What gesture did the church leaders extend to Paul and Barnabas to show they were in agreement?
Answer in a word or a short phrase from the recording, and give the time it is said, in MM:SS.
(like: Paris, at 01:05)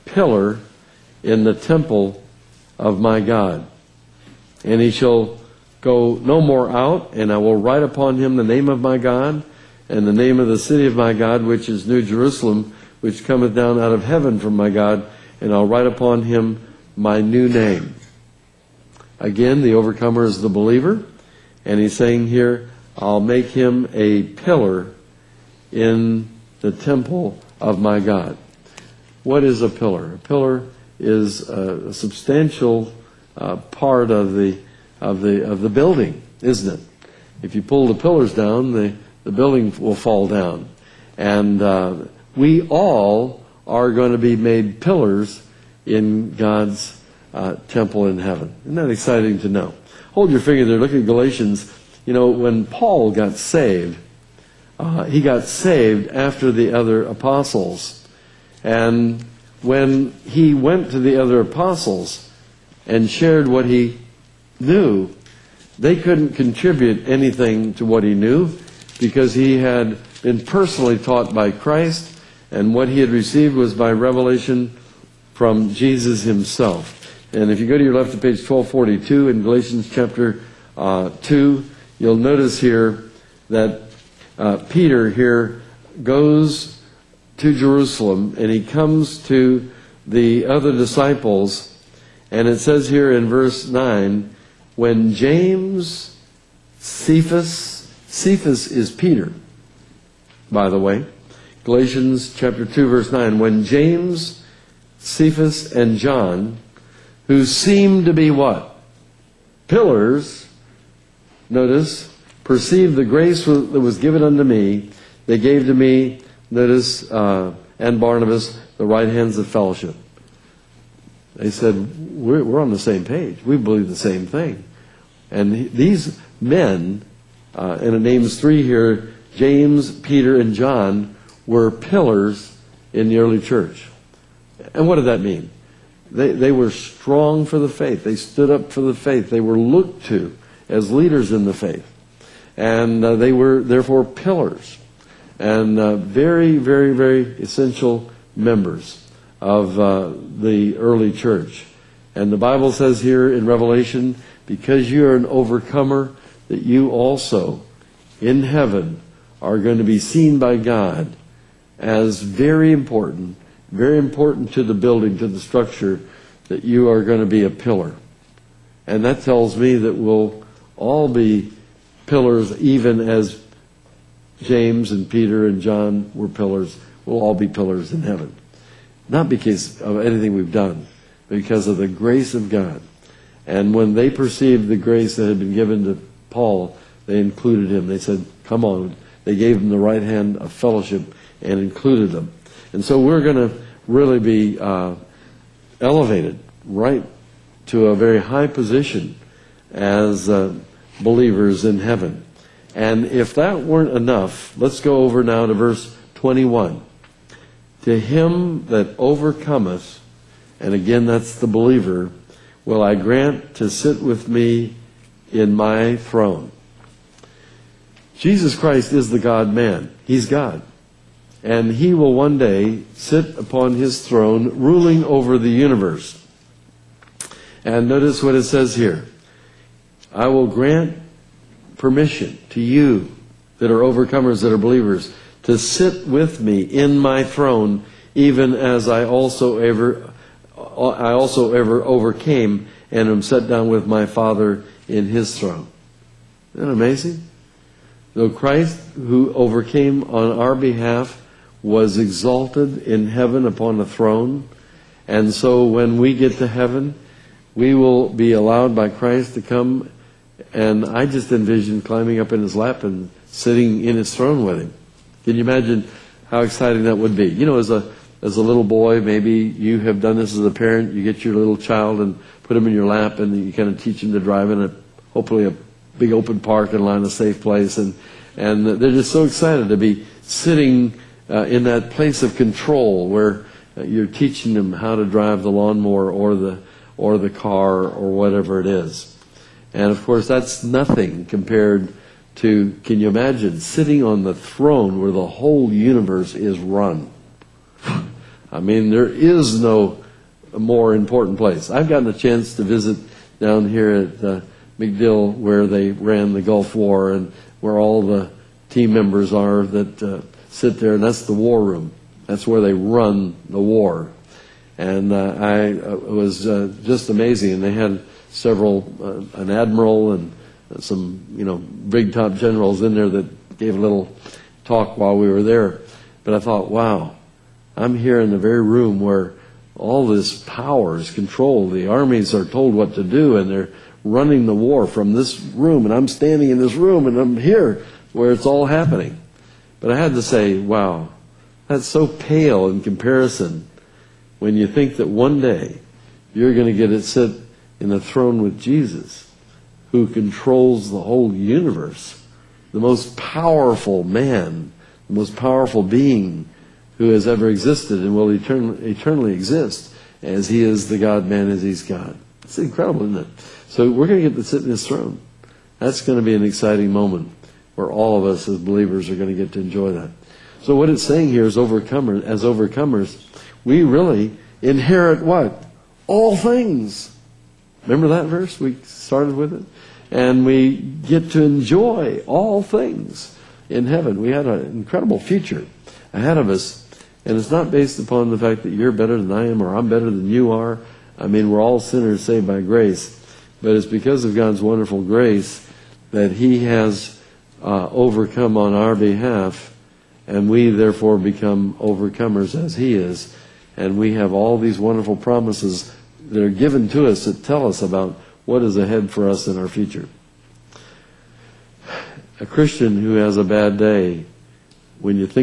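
Right hands of fellowship, at 01:58.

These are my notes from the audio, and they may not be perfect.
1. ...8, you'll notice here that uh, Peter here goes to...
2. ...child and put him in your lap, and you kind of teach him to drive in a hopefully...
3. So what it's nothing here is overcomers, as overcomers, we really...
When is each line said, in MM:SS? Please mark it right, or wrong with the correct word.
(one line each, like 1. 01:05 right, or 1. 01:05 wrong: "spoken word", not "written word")
1. 01:21 wrong: "2", not "8"
2. 04:31 right
3. 06:10 wrong: "saying", not "nothing".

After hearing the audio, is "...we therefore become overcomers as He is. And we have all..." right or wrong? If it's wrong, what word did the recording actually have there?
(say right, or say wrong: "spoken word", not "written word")
right.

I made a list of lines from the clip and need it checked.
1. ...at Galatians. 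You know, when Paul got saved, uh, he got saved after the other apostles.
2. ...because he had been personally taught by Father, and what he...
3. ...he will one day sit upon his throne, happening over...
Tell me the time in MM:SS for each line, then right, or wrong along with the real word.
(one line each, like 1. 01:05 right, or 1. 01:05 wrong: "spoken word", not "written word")
1. 00:50 right
2. 01:08 wrong: "Christ", not "Father"
3. 03:41 wrong: "ruling", not "happening".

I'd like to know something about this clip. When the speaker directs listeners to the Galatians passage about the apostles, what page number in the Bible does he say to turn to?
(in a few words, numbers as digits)
1242.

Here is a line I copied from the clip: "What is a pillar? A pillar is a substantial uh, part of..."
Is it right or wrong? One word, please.
right.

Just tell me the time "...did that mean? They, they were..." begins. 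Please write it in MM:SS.
02:14.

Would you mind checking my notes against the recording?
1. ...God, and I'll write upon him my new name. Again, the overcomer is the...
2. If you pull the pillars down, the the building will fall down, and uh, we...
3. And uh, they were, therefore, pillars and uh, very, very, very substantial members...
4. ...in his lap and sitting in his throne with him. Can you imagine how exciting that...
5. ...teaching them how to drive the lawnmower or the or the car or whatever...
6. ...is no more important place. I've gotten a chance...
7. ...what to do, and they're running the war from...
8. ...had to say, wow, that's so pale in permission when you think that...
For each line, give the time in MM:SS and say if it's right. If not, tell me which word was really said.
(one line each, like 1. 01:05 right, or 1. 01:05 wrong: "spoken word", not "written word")
1. 00:14 right
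2. 00:37 right
3. 02:22 wrong: "essential", not "substantial"
4. 04:22 right
5. 04:44 right
6. 04:59 right
7. 05:32 right
8. 05:39 wrong: "comparison", not "permission".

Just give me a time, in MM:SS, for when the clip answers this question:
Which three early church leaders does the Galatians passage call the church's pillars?
01:43.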